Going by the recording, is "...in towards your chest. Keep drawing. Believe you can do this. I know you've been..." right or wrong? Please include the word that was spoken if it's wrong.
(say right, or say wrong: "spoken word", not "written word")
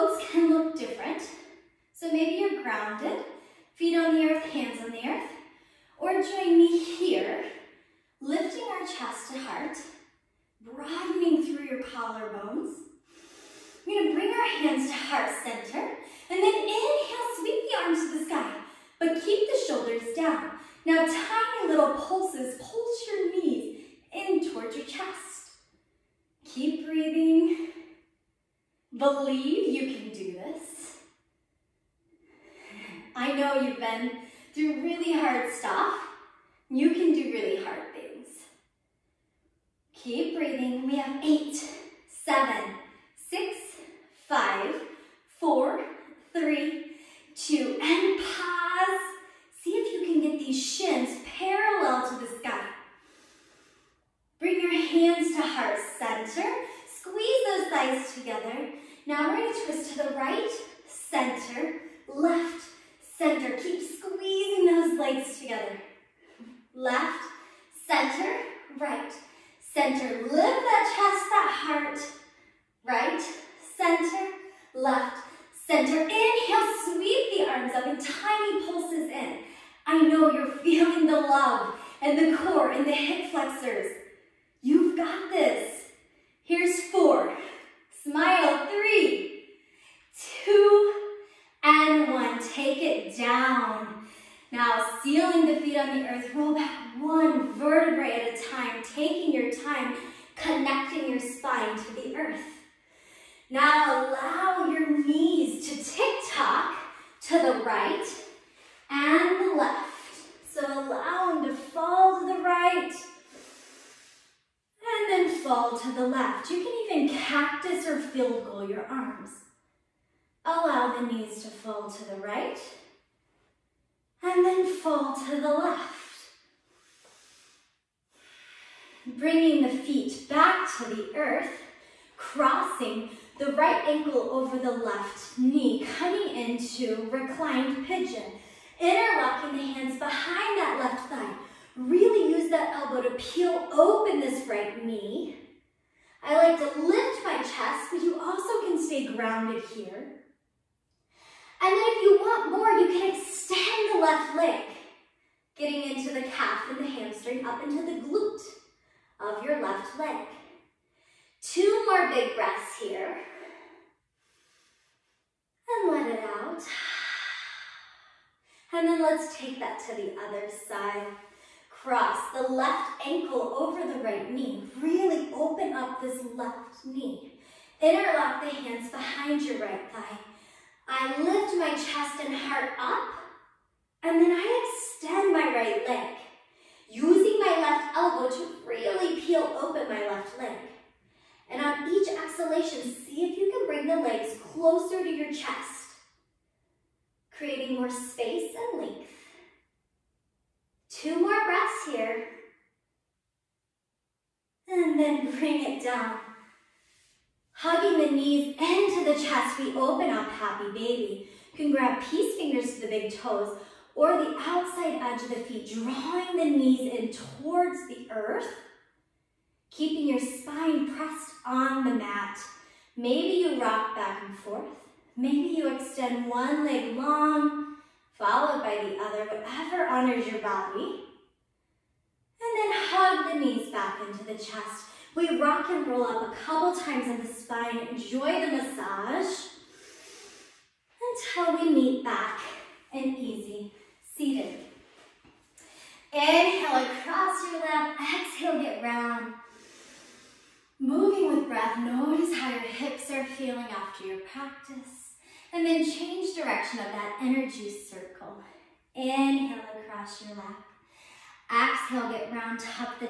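wrong: "breathing", not "drawing".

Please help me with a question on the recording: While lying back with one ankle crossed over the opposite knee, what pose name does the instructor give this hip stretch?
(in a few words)
Reclined pigeon.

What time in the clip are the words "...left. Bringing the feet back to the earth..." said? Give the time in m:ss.
2:05.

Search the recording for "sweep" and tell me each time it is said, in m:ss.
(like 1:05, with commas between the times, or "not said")
0:17, 1:16.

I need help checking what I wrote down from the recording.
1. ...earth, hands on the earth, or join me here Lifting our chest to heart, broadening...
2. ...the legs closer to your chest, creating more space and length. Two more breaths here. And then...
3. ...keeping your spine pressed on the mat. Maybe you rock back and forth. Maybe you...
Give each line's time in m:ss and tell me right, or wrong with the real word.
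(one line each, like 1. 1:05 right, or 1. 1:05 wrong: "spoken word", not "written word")
1. 0:04 right
2. 3:13 right
3. 3:39 right.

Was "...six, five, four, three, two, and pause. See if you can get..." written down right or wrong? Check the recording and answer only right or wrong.
right.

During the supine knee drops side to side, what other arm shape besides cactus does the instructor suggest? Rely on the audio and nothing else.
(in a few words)
Field goal.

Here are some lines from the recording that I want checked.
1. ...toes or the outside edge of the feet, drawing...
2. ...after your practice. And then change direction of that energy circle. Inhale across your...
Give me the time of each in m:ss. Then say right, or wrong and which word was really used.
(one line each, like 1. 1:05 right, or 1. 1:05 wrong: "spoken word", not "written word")
1. 3:33 right
2. 4:13 right.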